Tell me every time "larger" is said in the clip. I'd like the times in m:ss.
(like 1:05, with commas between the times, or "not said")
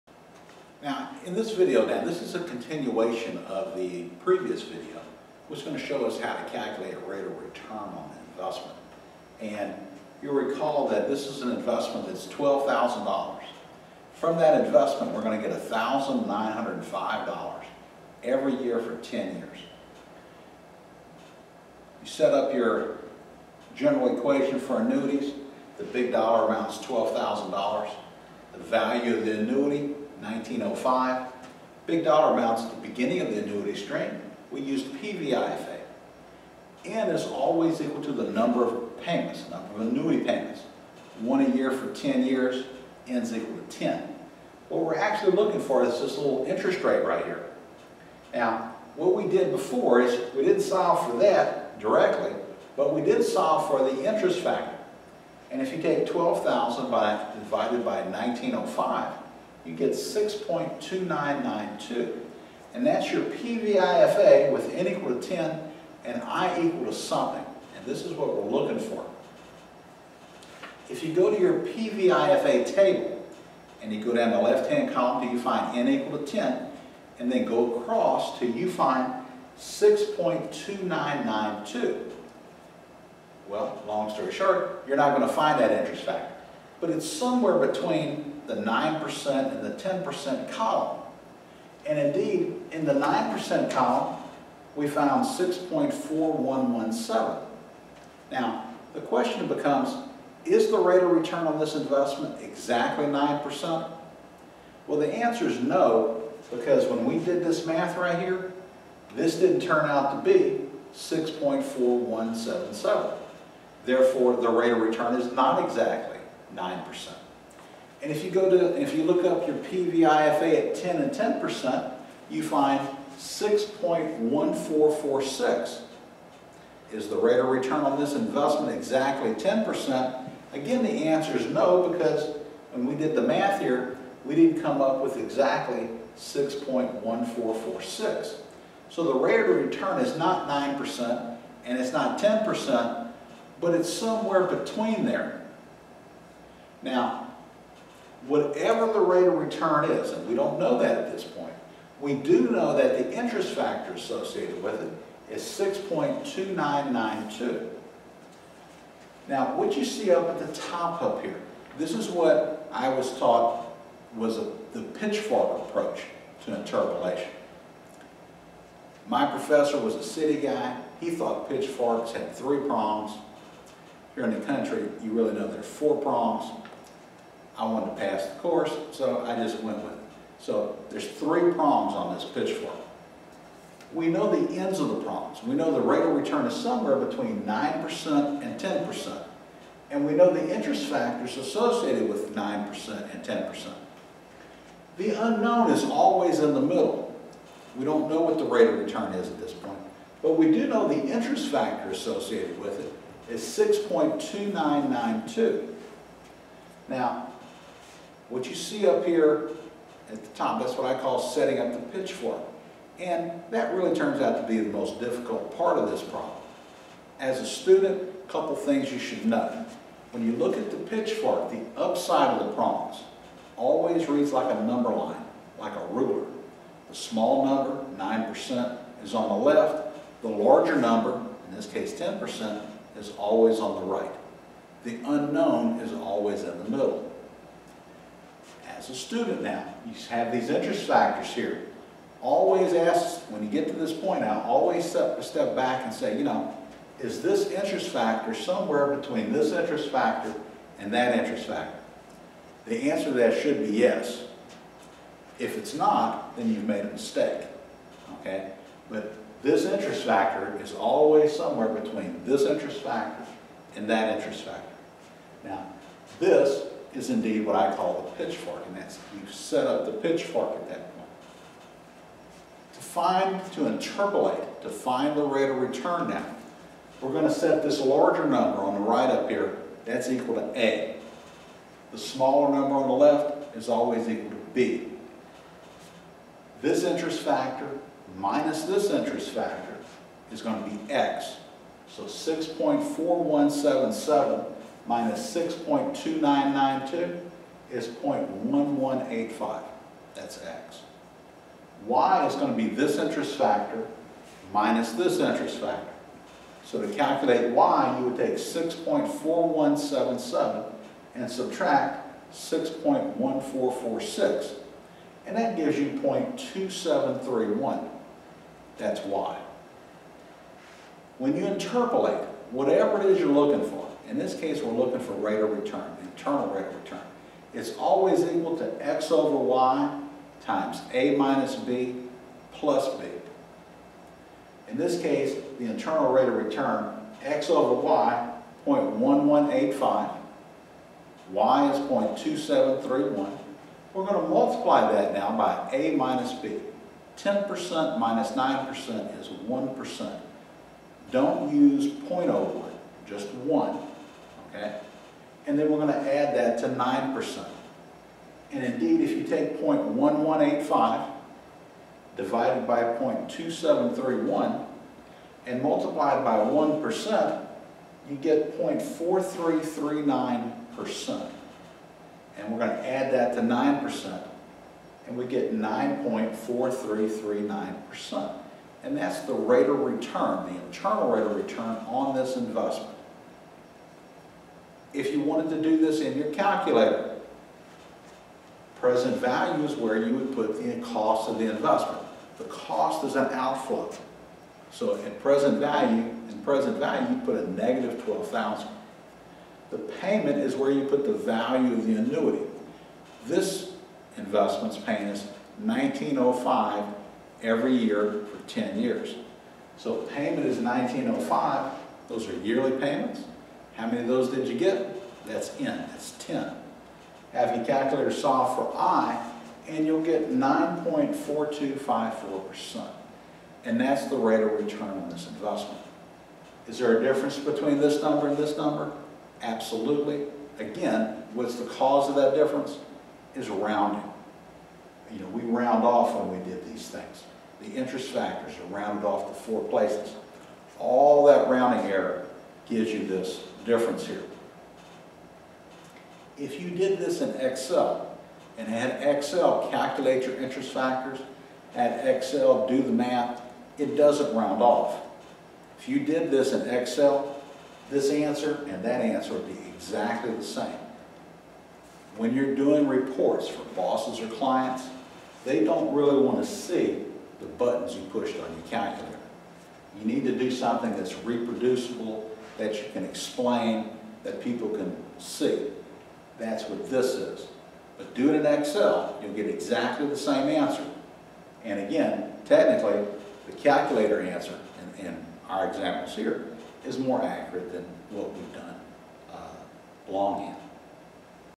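3:50, 4:37.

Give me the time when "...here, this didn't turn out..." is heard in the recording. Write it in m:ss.
1:48.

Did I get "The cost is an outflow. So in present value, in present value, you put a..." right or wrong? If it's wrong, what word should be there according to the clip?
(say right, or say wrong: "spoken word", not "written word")
right.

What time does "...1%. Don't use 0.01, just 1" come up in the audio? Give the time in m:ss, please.
5:49.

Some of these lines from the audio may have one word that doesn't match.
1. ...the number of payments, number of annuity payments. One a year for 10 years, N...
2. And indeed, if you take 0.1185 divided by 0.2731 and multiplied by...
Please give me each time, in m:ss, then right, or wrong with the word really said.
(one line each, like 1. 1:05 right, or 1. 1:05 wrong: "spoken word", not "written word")
1. 0:38 right
2. 5:58 right.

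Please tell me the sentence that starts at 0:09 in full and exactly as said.
And you'll recall that this is an investment that's $12,000.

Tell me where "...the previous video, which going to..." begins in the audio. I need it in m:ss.
0:03.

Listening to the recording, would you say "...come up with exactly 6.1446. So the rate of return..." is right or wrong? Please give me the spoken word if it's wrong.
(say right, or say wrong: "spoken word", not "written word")
right.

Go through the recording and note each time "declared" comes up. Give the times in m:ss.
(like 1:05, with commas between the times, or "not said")
not said.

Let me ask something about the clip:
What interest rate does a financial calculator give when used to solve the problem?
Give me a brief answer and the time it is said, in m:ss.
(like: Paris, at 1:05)
9.4254%, at 7:00.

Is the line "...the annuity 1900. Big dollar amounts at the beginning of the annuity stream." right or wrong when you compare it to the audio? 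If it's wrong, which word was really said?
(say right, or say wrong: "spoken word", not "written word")
wrong: "1905", not "1900".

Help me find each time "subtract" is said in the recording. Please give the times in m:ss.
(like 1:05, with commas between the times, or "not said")
5:11.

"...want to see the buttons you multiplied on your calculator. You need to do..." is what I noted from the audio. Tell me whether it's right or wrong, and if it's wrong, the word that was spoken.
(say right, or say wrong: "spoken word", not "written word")
wrong: "pushed", not "multiplied".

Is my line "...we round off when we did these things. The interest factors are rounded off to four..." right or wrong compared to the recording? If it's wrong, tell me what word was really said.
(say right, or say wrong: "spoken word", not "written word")
right.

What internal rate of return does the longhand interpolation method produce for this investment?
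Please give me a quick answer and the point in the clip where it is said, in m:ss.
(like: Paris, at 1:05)
9.4339%, at 6:15.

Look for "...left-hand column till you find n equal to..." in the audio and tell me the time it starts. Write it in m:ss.
1:14.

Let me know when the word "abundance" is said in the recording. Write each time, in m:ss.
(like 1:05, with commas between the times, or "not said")
not said.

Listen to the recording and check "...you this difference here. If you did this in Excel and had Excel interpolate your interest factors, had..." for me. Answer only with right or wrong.
wrong.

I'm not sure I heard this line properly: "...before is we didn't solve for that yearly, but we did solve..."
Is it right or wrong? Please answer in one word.
wrong.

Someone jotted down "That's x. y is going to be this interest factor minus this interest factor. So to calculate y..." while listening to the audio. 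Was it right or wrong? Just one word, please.
right.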